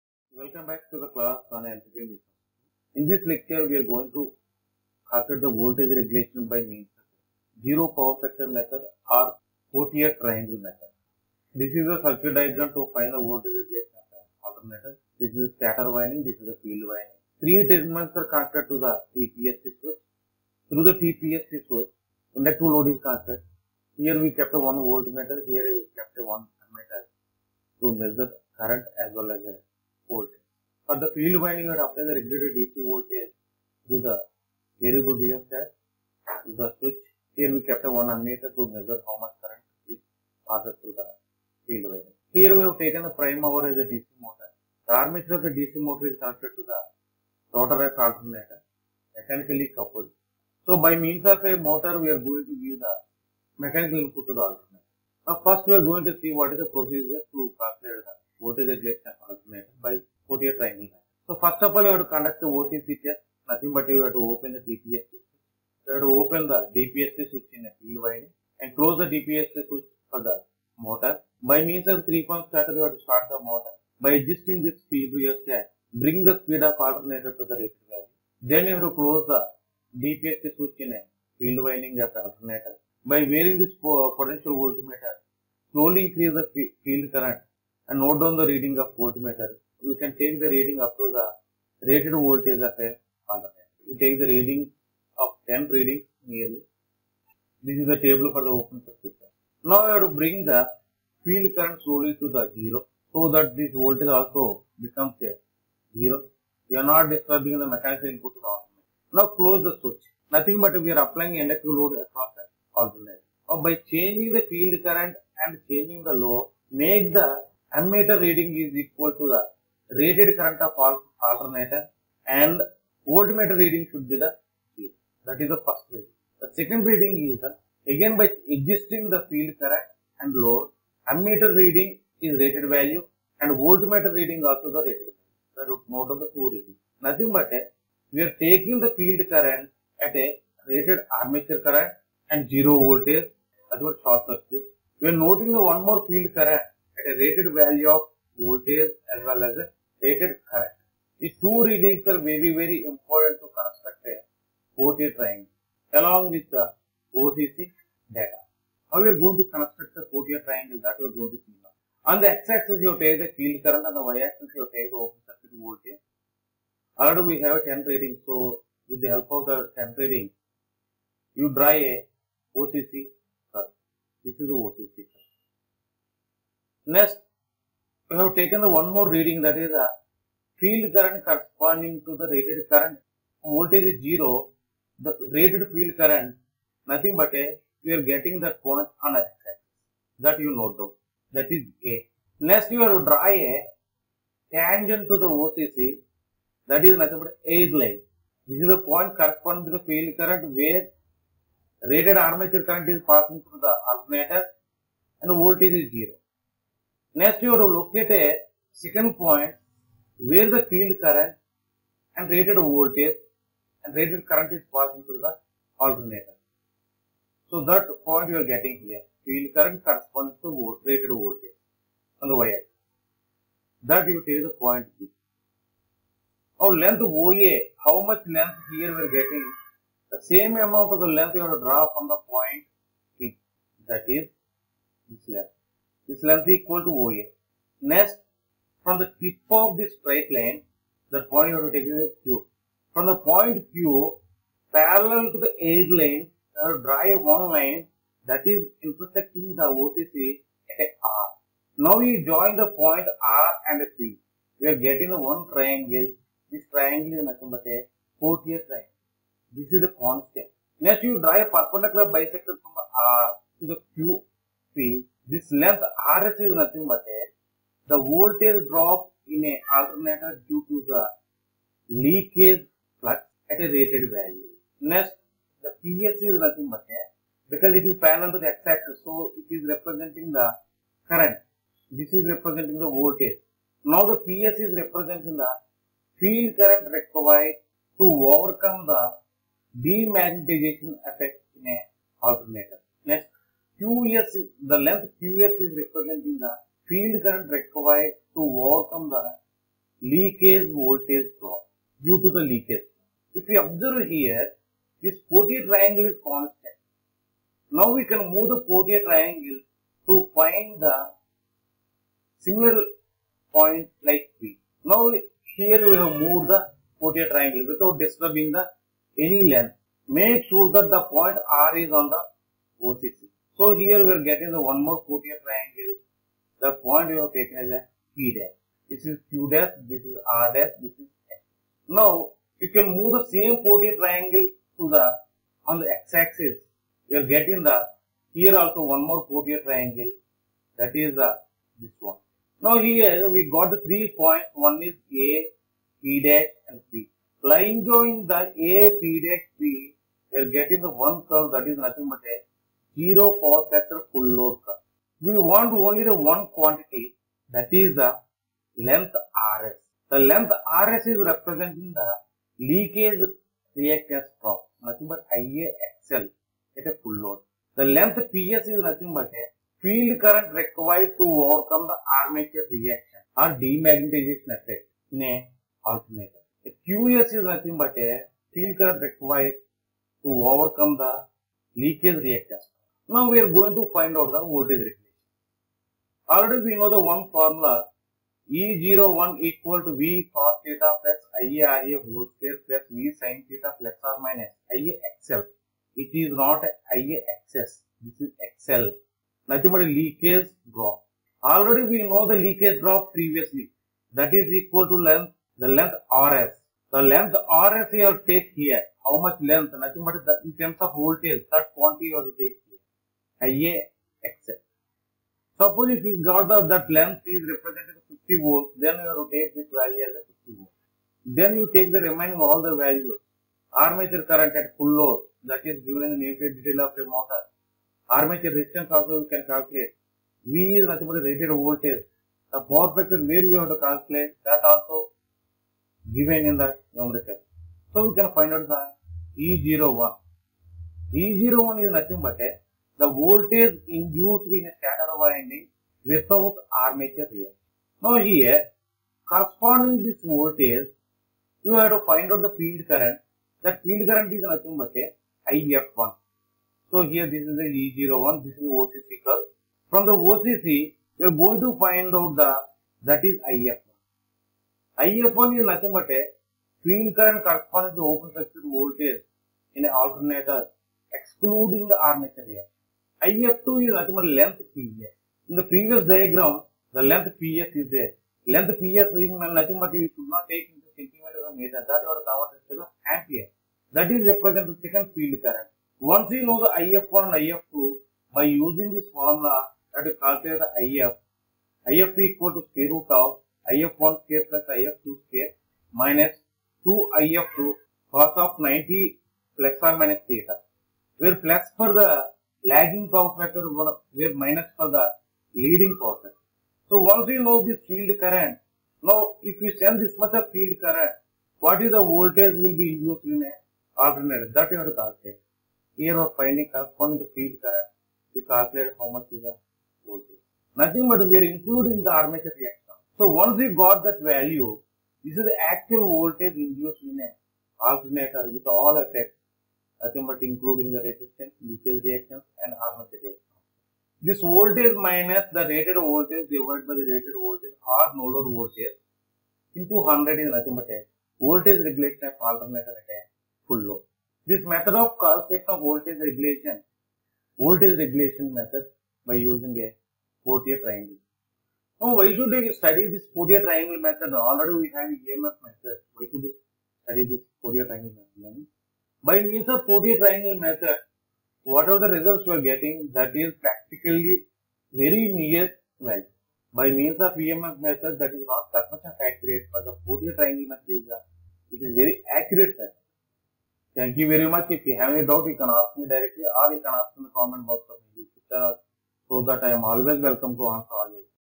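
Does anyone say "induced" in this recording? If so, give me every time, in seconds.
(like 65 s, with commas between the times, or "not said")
443 s, 512 s, 526 s.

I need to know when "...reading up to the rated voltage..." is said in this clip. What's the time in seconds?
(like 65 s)
90 s.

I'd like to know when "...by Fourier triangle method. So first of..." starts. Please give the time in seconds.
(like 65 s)
59 s.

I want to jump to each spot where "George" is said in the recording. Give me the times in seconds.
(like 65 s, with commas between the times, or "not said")
not said.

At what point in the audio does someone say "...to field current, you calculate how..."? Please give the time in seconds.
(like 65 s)
517 s.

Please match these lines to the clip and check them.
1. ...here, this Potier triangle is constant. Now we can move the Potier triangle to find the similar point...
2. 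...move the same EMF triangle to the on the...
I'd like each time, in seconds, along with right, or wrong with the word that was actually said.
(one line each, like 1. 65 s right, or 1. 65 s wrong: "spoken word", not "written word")
1. 304 s right
2. 332 s wrong: "Potier", not "EMF".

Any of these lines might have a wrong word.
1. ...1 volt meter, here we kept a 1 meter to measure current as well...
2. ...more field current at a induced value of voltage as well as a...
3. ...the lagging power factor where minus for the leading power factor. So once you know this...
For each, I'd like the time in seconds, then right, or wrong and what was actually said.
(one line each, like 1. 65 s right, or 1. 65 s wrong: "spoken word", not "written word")
1. 24 s right
2. 145 s wrong: "rated", not "induced"
3. 501 s right.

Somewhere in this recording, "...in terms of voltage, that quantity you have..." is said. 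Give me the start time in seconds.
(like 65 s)
410 s.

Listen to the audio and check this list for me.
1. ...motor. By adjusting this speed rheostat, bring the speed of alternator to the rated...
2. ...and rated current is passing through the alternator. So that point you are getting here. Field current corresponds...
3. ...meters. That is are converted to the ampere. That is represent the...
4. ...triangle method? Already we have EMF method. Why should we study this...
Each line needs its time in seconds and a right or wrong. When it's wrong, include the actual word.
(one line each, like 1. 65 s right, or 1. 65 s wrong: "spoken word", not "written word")
1. 73 s right
2. 213 s right
3. 481 s right
4. 553 s right.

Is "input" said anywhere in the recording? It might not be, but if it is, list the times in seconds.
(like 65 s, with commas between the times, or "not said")
53 s, 108 s.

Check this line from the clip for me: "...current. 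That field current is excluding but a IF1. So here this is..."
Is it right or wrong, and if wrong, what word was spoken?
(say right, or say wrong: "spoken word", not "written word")
wrong: "nothing", not "excluding".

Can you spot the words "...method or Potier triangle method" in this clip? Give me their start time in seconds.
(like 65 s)
8 s.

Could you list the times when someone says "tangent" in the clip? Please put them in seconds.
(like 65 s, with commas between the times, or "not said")
194 s.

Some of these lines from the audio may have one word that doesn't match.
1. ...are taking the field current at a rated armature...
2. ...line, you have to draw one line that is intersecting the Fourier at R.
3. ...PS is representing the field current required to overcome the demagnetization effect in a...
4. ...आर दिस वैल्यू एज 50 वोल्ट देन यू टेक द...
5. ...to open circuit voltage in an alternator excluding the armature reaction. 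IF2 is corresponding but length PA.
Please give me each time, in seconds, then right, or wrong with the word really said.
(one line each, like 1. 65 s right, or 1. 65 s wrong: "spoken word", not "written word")
1. 138 s right
2. 245 s wrong: "OCC", not "Fourier"
3. 284 s right
4. 419 s right
5. 467 s wrong: "nothing", not "corresponding".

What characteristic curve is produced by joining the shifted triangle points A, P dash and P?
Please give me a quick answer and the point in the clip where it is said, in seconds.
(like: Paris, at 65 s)
zero power factor full load, at 352 s.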